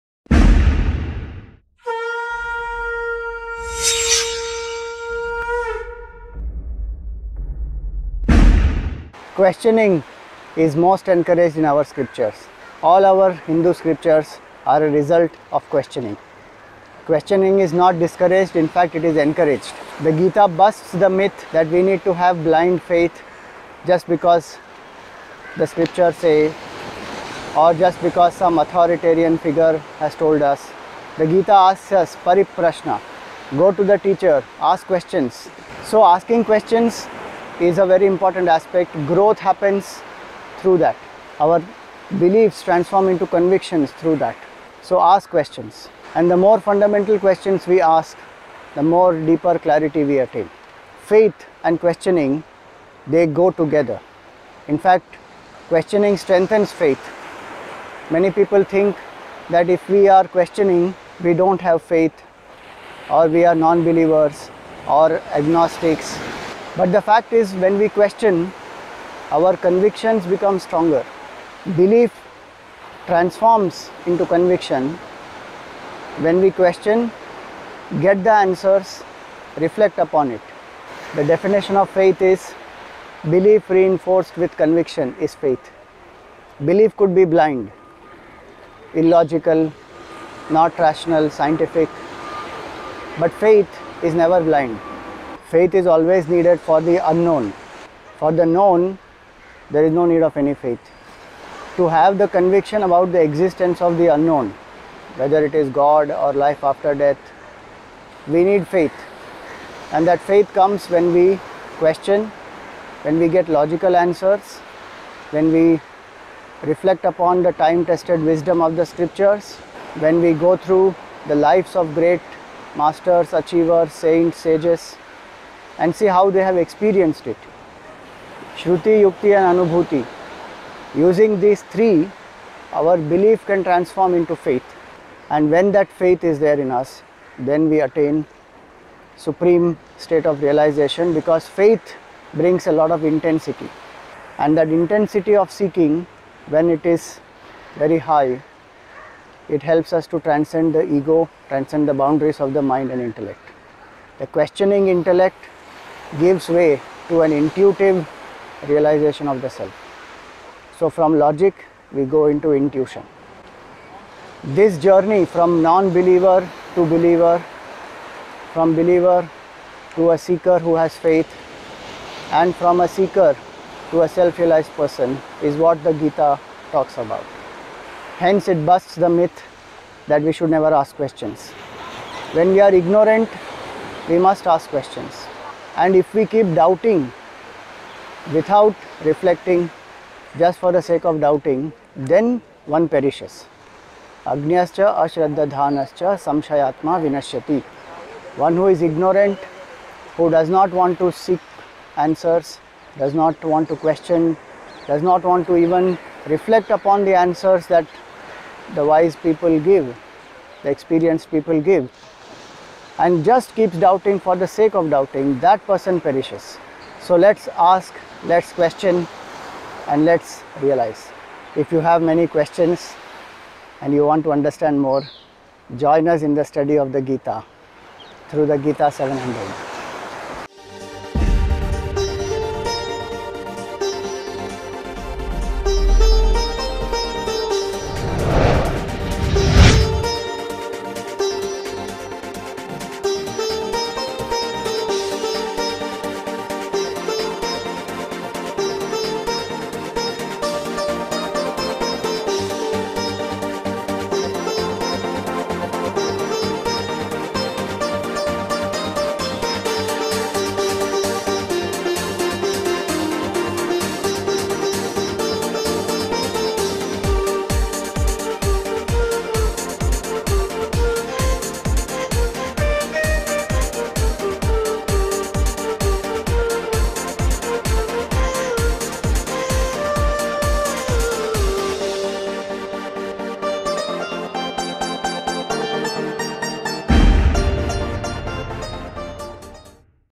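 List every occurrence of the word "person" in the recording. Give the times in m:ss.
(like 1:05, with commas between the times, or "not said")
2:54, 3:35.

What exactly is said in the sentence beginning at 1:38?
For the known, there is no need of any faith.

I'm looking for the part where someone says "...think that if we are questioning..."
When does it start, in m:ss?
0:58.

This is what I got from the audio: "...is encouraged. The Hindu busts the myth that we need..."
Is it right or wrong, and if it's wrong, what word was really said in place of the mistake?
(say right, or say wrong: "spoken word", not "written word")
wrong: "Gita", not "Hindu".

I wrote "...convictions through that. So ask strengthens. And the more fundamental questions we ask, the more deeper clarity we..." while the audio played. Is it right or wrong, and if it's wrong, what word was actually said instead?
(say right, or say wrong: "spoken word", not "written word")
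wrong: "questions", not "strengthens".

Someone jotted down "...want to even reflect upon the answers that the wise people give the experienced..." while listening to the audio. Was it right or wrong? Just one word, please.
right.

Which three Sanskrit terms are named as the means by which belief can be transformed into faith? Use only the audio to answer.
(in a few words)
Shruti, Yukti and Anubhuti.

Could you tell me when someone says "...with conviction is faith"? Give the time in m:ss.
1:24.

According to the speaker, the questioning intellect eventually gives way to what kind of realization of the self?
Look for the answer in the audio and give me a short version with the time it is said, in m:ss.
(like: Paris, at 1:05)
Intuitive realization, at 2:37.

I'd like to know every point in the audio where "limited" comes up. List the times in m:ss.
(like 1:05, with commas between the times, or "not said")
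not said.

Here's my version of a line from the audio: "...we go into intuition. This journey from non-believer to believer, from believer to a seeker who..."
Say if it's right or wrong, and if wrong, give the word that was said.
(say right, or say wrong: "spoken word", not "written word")
right.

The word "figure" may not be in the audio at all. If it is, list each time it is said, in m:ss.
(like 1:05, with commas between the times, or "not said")
0:29.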